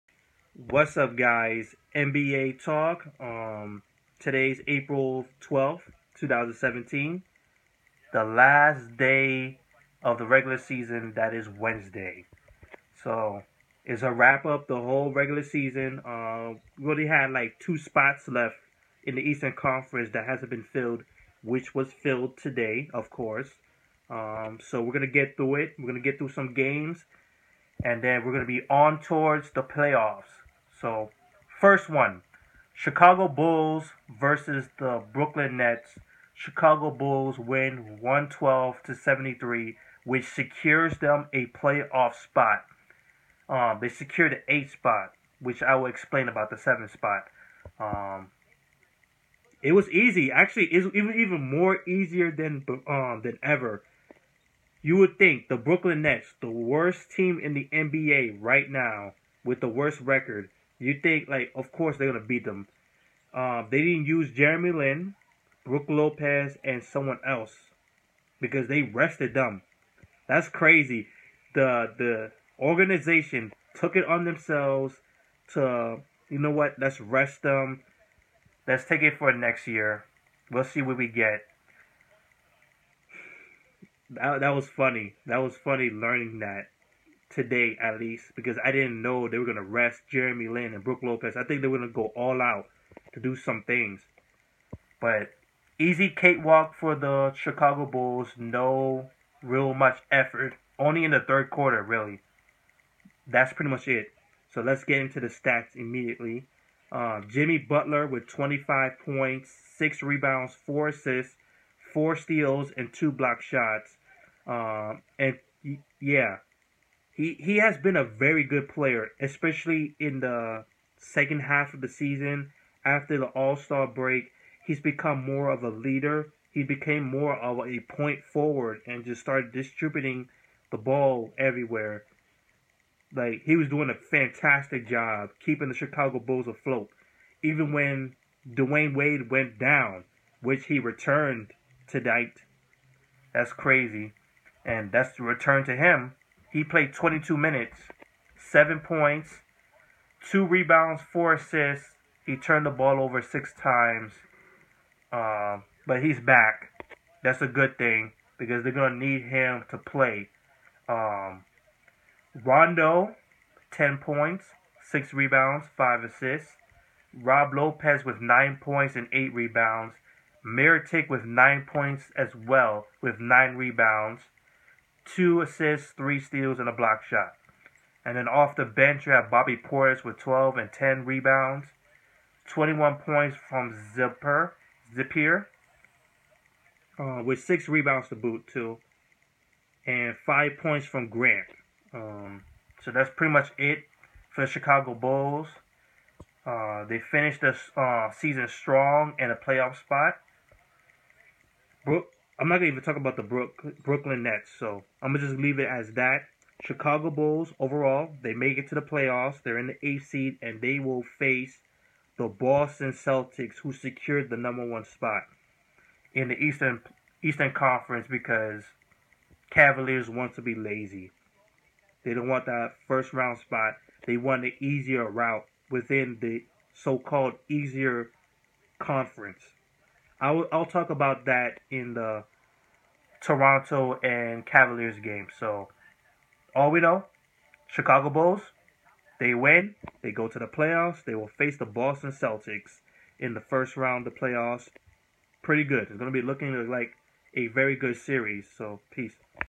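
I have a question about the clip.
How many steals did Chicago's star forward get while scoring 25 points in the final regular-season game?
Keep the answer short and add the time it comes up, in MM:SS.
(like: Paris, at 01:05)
4, at 01:51.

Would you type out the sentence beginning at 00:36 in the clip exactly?
Chicago Bulls win 112 to 73, which secures them a playoff spot.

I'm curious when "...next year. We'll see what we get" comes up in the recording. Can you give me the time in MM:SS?
01:19.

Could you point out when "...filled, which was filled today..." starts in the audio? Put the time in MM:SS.
00:20.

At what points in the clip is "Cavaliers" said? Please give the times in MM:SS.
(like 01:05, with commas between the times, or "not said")
03:39, 03:54.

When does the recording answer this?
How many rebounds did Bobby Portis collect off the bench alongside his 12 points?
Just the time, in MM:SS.
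03:00.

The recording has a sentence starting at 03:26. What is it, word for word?
Chicago Bulls overall, they make it to the playoffs.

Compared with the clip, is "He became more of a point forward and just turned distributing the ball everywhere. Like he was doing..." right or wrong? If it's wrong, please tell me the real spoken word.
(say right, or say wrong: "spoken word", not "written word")
wrong: "started", not "turned".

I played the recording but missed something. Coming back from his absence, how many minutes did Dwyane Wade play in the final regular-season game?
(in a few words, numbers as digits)
22.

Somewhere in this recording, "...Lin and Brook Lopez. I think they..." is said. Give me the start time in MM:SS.
01:30.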